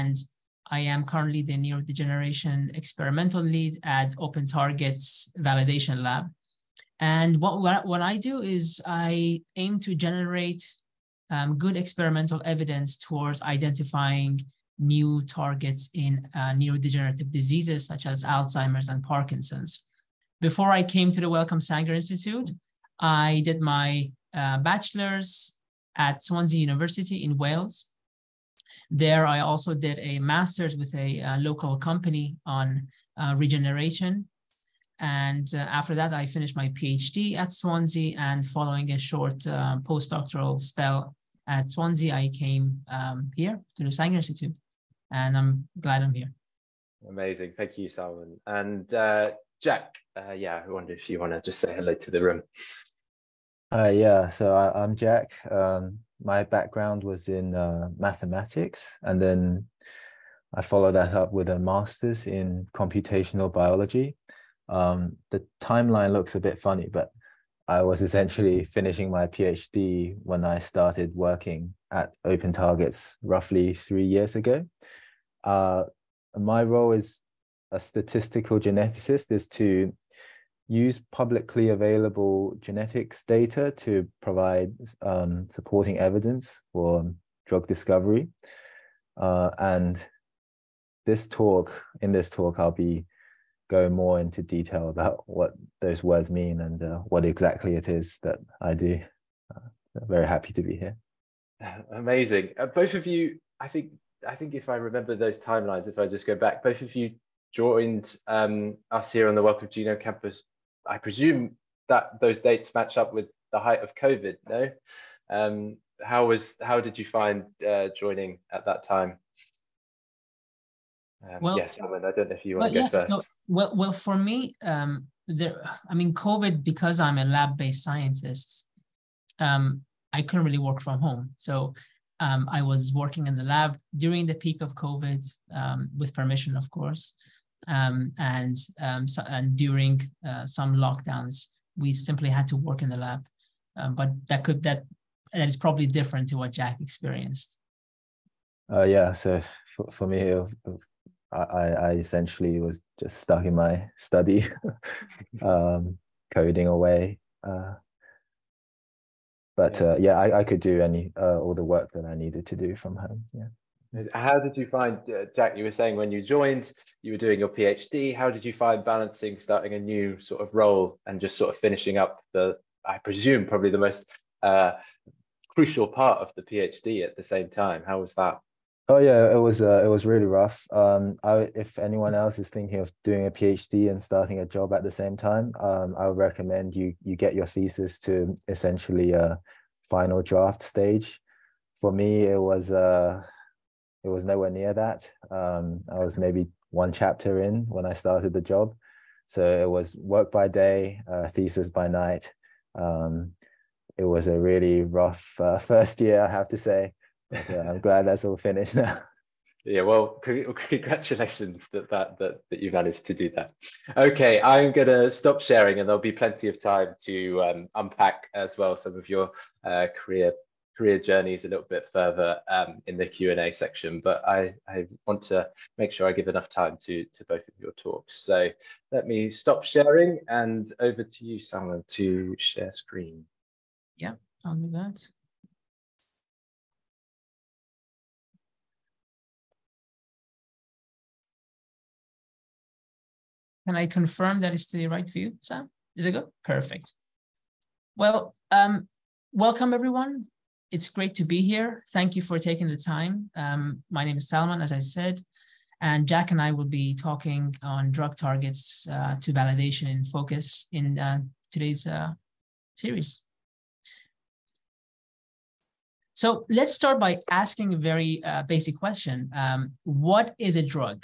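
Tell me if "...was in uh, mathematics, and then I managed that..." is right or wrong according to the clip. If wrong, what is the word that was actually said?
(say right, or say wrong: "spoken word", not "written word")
wrong: "followed", not "managed".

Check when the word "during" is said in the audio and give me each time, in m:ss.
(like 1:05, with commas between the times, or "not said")
2:13, 2:19.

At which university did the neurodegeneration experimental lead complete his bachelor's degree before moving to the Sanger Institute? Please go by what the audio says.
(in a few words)
Swansea University.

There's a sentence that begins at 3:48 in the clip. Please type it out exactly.
So let me stop sharing and over to you, Sam, to share screen.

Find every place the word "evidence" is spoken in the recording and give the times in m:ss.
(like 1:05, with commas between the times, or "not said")
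0:12, 1:25.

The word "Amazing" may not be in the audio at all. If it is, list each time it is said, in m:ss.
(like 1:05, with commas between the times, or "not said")
0:47, 1:41.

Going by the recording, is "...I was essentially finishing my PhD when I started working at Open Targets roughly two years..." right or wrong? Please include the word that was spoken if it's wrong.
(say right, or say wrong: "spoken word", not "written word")
wrong: "three", not "two".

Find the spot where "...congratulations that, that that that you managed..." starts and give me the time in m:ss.
3:30.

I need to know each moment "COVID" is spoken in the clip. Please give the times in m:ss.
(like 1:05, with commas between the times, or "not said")
1:53, 2:06, 2:14.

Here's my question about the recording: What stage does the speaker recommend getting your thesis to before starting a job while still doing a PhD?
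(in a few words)
Final draft stage.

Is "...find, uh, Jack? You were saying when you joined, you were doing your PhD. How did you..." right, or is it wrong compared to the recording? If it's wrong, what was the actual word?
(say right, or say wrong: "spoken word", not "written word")
right.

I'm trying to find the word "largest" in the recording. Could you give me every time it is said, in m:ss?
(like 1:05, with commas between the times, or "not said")
not said.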